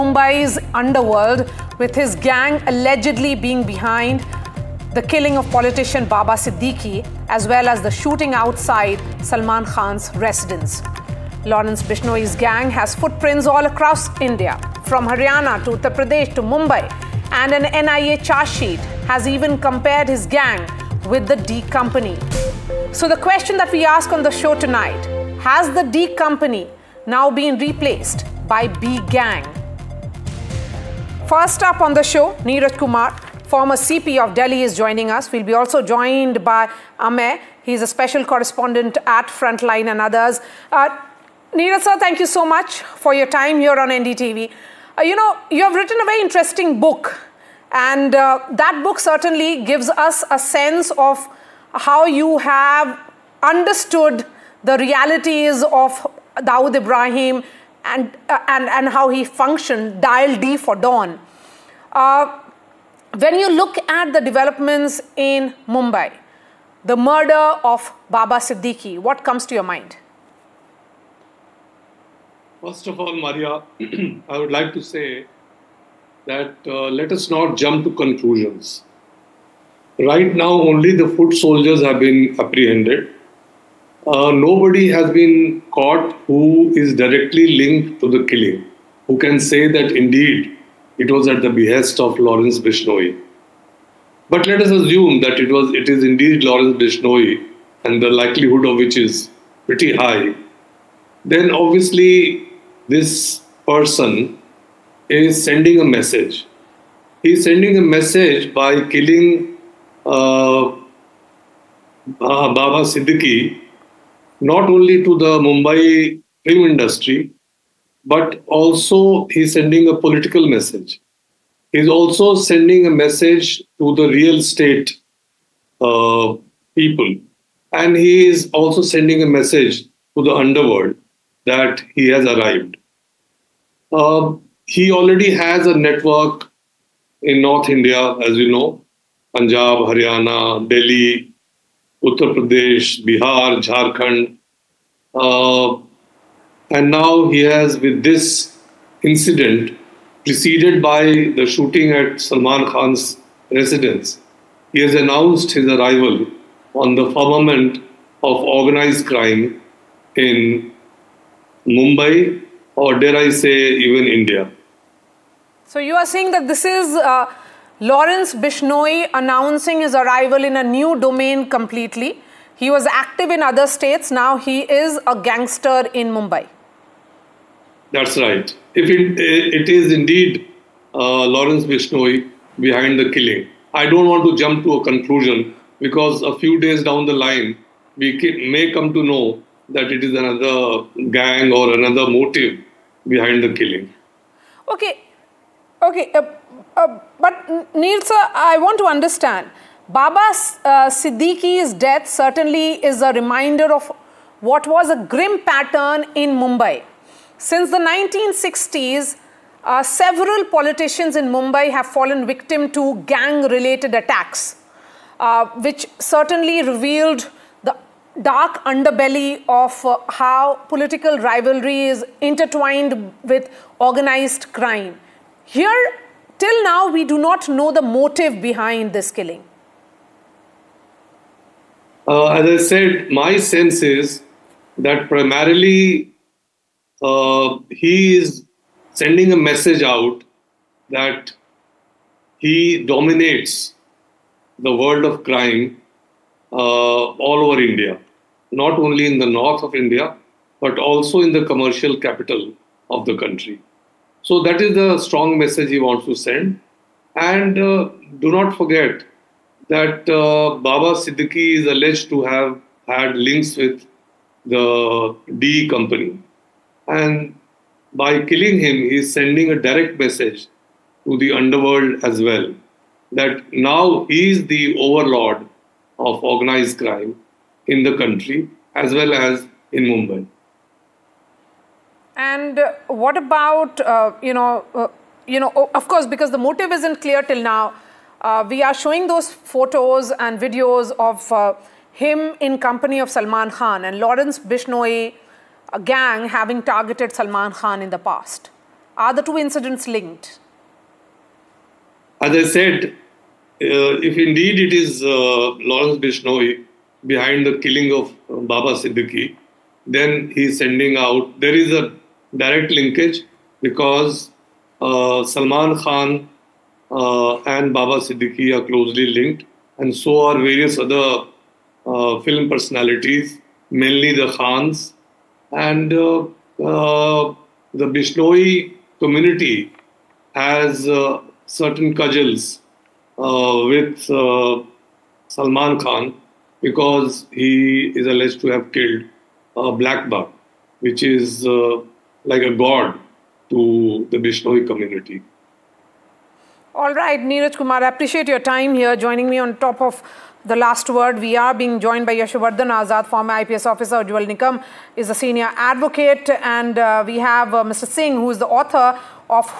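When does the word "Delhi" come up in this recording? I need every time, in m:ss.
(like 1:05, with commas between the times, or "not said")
0:34, 2:20.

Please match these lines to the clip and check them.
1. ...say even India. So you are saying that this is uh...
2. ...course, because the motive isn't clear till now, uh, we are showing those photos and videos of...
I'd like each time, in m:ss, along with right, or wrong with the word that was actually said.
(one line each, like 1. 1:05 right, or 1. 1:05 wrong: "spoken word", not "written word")
1. 2:43 right
2. 4:45 right.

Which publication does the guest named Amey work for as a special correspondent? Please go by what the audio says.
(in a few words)
Frontline.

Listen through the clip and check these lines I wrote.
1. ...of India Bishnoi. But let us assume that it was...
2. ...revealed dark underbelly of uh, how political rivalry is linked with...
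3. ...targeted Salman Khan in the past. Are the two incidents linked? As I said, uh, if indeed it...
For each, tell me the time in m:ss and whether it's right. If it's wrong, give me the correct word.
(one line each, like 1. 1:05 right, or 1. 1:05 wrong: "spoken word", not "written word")
1. 1:31 wrong: "Lawrence", not "India"
2. 3:36 wrong: "intertwined", not "linked"
3. 4:56 right.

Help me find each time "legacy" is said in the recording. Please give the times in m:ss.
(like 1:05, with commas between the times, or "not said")
not said.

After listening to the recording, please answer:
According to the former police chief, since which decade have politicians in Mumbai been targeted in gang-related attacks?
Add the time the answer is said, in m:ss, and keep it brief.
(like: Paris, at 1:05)
1960s, at 3:27.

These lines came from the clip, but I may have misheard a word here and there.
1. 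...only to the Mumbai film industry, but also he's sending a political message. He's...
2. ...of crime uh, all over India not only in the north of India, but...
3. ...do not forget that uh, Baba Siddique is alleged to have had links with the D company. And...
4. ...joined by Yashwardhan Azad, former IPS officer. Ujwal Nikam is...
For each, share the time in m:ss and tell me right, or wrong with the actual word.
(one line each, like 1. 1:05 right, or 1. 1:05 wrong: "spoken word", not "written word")
1. 1:54 right
2. 4:05 right
3. 4:18 right
4. 5:51 right.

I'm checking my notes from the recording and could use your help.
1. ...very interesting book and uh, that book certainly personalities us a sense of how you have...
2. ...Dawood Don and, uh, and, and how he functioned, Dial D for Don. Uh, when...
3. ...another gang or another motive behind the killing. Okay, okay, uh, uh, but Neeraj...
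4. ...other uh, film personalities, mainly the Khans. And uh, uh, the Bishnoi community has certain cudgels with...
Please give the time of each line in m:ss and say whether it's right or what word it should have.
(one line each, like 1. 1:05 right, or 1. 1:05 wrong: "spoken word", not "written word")
1. 0:46 wrong: "gives", not "personalities"
2. 0:56 wrong: "Ibrahim", not "Don"
3. 3:10 wrong: "Neil", not "Neeraj"
4. 5:20 right.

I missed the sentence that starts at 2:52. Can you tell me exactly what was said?
He was active in other states.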